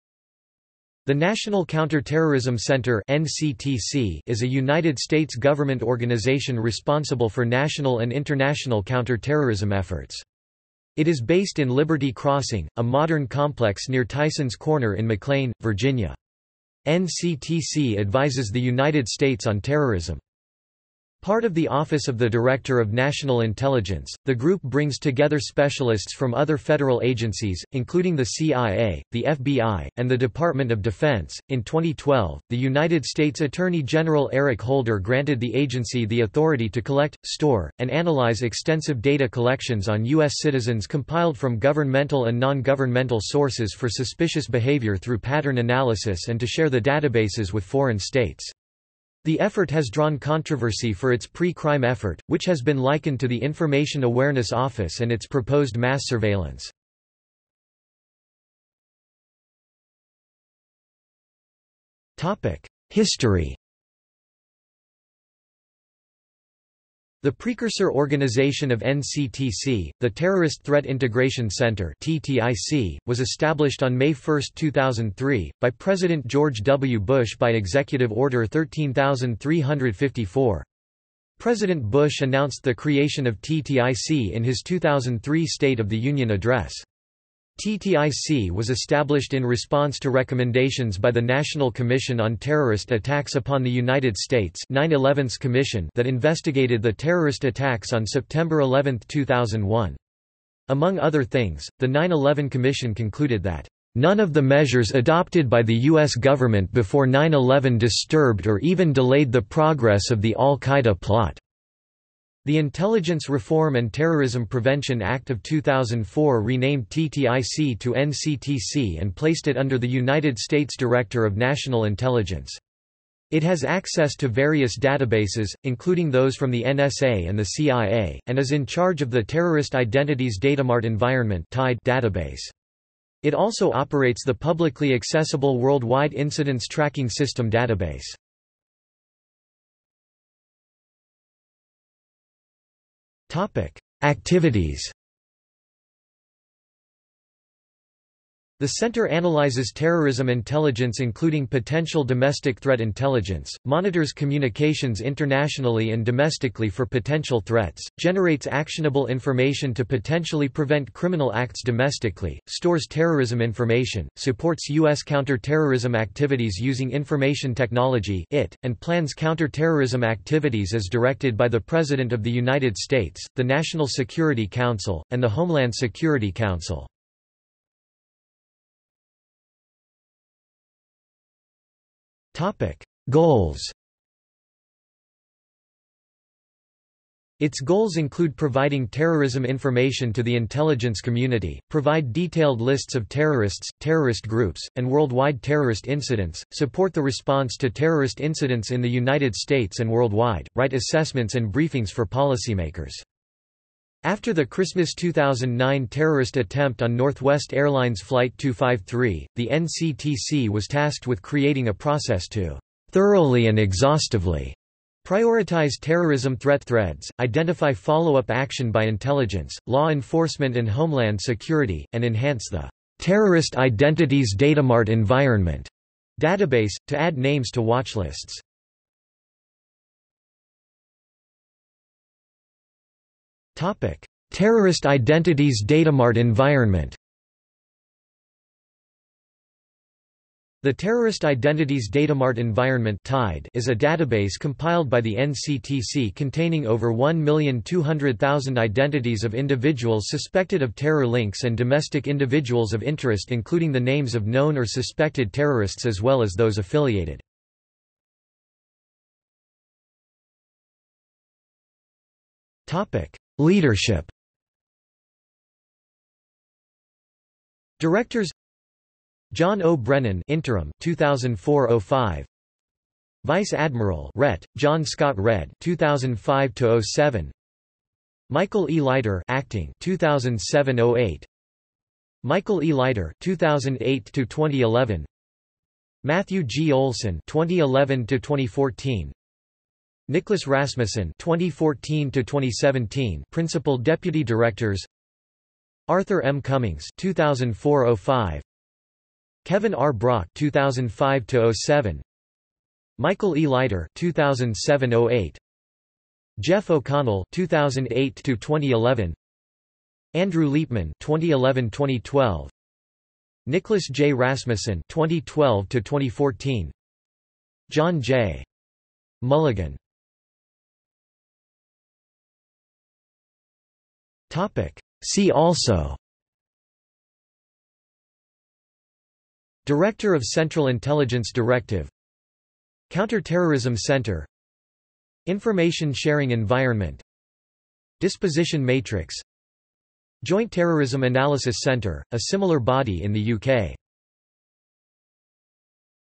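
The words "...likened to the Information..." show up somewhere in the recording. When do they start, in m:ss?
0:52.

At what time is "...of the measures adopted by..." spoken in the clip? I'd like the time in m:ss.
1:44.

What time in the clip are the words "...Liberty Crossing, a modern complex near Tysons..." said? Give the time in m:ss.
0:11.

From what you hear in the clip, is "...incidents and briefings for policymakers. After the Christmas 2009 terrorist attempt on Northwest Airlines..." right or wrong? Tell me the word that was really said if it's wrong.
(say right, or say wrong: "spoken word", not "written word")
wrong: "assessments", not "incidents".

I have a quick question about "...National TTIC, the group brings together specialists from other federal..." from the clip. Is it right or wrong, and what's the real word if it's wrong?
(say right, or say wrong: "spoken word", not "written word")
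wrong: "Intelligence", not "TTIC".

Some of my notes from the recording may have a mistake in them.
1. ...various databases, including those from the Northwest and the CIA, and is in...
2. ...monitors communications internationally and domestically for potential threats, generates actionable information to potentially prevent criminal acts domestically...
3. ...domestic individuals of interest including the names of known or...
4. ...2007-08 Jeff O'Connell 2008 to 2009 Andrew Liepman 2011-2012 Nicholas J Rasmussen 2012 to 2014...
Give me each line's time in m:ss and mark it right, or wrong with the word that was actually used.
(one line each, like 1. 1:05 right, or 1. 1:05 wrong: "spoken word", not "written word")
1. 2:04 wrong: "NSA", not "Northwest"
2. 2:33 right
3. 4:11 right
4. 5:03 wrong: "2011", not "2009".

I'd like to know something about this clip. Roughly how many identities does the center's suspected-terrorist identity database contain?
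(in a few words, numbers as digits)
1,200,000.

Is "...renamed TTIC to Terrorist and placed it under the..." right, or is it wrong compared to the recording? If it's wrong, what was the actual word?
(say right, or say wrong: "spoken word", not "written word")
wrong: "NCTC", not "Terrorist".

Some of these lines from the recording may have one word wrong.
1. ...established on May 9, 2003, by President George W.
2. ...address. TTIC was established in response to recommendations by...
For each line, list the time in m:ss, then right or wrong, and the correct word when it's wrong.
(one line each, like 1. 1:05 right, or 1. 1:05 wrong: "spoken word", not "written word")
1. 1:13 wrong: "1", not "9"
2. 1:26 right.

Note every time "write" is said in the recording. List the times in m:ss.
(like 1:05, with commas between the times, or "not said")
3:20.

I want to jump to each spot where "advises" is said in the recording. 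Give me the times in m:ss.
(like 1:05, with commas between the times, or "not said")
0:17.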